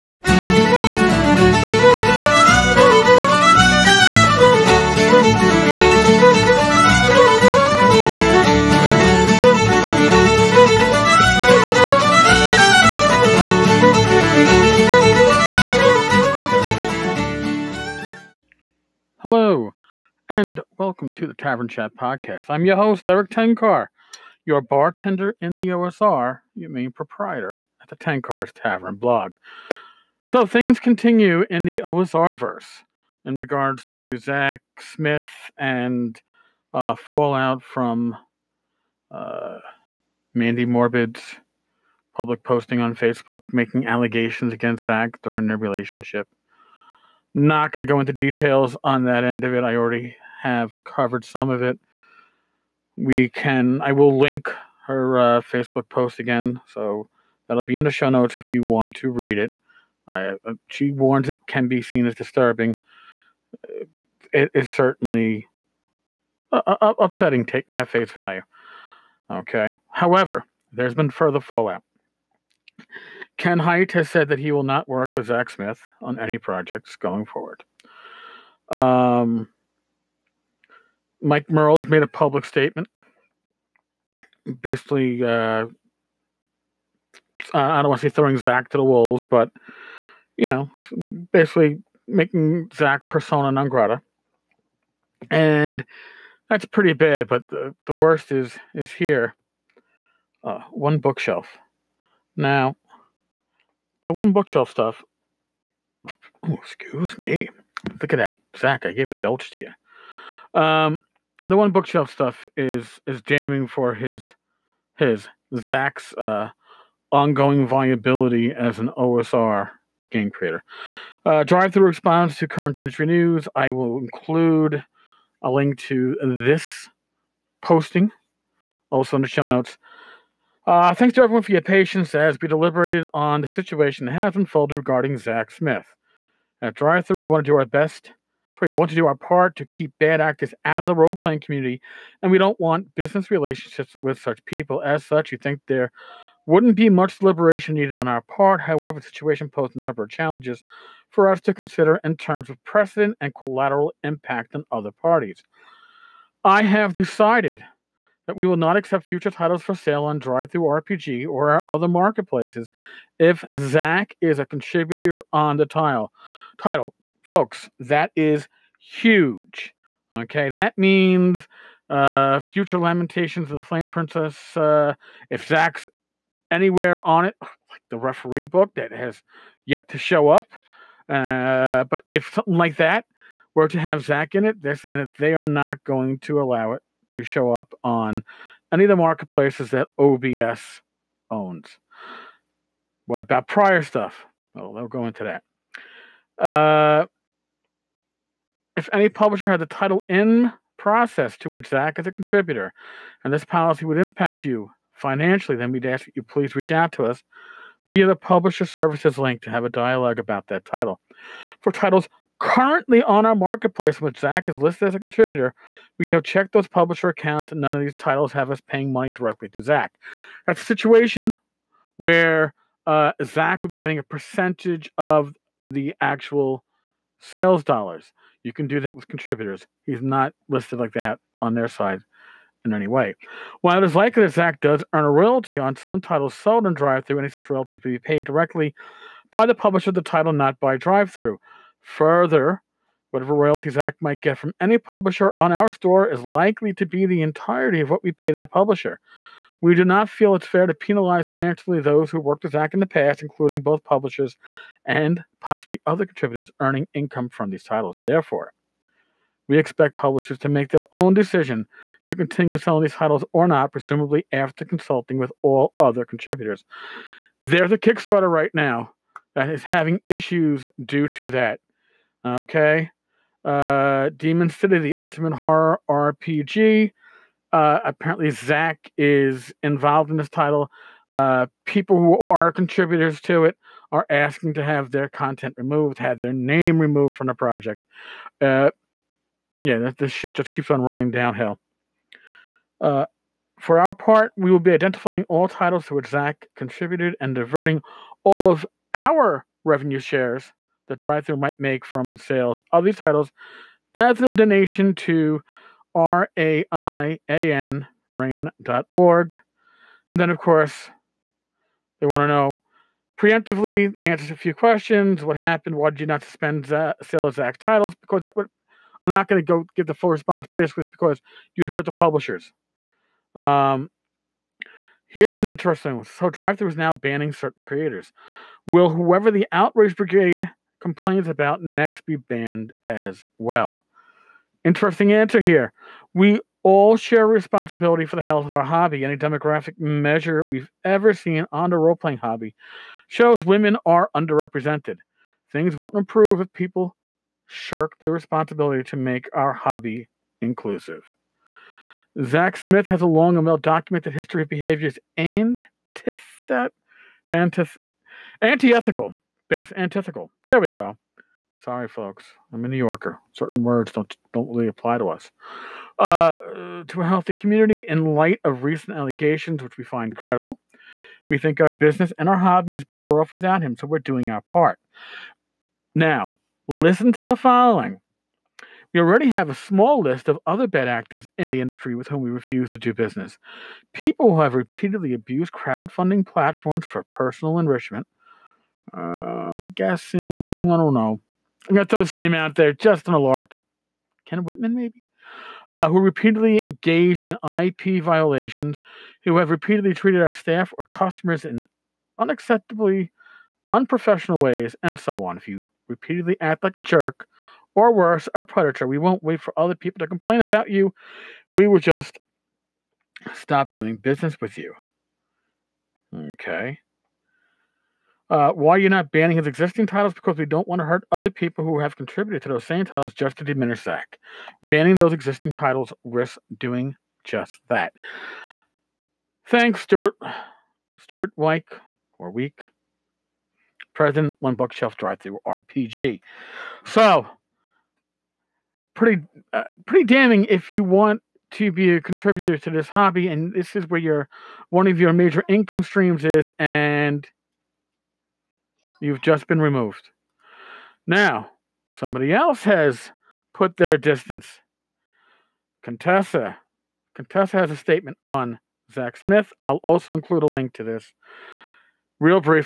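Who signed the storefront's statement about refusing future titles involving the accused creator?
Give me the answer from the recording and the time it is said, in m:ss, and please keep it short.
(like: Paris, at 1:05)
Stuart Wieck, at 7:10.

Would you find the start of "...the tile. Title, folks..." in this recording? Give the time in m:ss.
2:45.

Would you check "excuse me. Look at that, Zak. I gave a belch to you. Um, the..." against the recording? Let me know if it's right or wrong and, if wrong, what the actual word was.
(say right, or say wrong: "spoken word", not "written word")
right.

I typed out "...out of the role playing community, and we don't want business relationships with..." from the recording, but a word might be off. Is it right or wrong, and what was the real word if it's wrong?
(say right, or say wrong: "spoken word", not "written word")
right.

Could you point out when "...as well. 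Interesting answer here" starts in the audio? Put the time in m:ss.
5:32.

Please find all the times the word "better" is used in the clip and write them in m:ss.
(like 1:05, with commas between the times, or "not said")
6:12.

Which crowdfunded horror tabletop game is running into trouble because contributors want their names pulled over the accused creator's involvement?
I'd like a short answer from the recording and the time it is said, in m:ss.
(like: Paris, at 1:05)
Demon City, at 4:34.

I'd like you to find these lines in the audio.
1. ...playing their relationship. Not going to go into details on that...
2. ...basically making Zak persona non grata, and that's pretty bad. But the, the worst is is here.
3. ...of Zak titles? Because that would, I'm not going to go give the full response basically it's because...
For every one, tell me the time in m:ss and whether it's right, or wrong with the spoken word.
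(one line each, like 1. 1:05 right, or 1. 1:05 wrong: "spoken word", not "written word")
1. 0:45 wrong: "during", not "playing"
2. 1:31 right
3. 5:17 right.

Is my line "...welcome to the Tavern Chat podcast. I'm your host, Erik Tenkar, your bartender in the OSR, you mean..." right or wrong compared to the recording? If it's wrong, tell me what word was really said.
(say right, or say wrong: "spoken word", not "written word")
right.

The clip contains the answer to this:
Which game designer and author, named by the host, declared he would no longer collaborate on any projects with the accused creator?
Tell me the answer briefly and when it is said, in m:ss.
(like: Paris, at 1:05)
Ken Hite, at 1:13.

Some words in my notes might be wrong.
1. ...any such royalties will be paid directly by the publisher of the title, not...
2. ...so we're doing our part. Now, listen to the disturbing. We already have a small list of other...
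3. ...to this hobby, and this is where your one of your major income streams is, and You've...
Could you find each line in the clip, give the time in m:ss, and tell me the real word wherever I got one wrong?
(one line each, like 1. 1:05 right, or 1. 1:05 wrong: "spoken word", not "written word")
1. 3:57 right
2. 6:13 wrong: "following", not "disturbing"
3. 7:22 right.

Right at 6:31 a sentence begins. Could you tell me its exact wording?
I'm going to throw this name out there Justin on a lark.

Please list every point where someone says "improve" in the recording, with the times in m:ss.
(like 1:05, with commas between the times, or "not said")
5:45.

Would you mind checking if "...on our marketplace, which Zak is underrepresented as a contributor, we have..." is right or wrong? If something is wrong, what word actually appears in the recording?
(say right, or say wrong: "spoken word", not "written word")
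wrong: "listed", not "underrepresented".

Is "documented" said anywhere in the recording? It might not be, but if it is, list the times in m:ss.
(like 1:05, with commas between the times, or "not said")
5:53.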